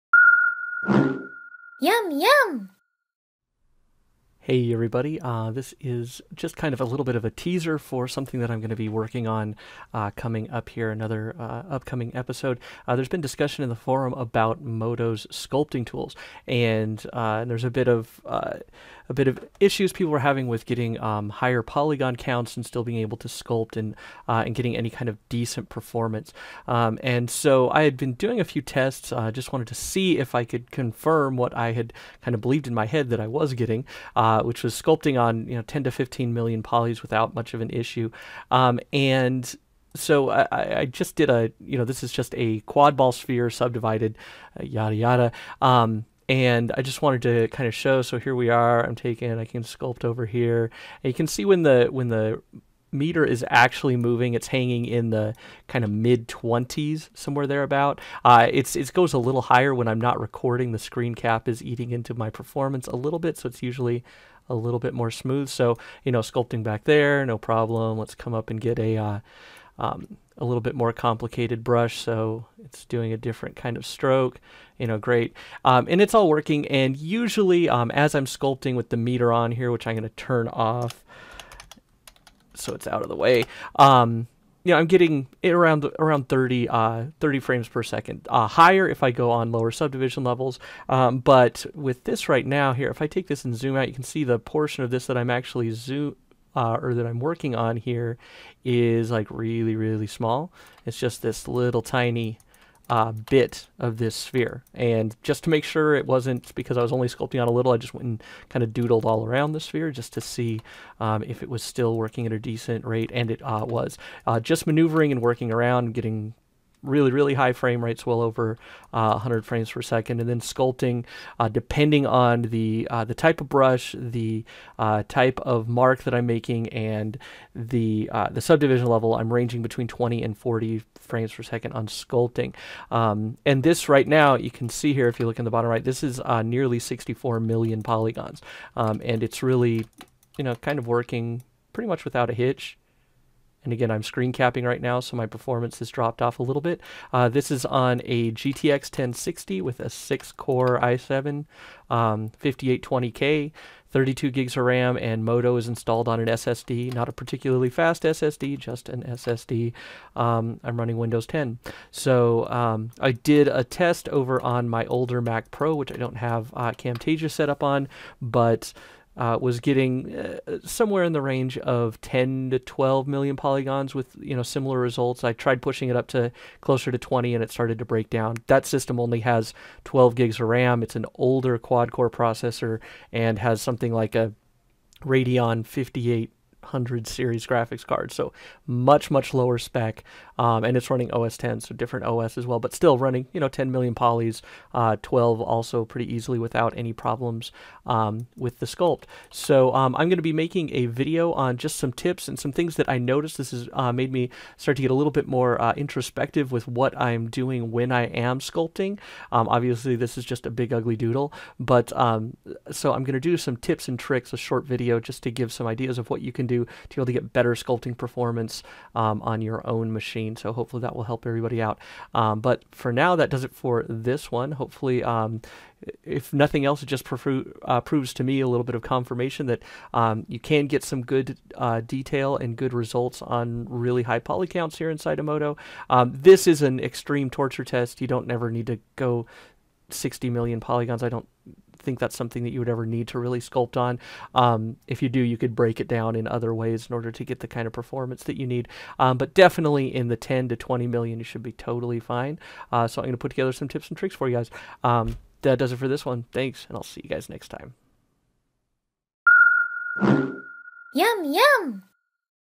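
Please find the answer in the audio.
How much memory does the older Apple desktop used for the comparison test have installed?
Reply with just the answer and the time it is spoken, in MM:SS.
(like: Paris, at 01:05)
12 gigs, at 02:59.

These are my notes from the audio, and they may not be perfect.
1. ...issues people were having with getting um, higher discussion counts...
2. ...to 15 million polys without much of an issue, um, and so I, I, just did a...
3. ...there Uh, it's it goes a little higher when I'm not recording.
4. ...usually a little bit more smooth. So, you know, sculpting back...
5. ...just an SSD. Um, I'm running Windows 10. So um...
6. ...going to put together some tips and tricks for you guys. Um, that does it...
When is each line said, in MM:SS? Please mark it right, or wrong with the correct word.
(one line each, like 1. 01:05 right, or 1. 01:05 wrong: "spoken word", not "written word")
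1. 00:19 wrong: "polygon", not "discussion"
2. 00:35 right
3. 00:57 right
4. 01:03 right
5. 02:38 right
6. 04:13 right.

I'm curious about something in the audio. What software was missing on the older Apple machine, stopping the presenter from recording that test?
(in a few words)
Camtasia.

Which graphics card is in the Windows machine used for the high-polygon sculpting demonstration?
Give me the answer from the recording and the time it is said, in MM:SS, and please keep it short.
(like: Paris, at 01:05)
GTX 1060, at 02:28.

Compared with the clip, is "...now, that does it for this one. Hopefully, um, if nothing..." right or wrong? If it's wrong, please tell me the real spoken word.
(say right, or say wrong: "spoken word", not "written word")
right.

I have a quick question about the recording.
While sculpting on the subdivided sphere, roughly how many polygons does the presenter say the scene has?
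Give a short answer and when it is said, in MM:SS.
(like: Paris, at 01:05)
nearly 64 million, at 02:16.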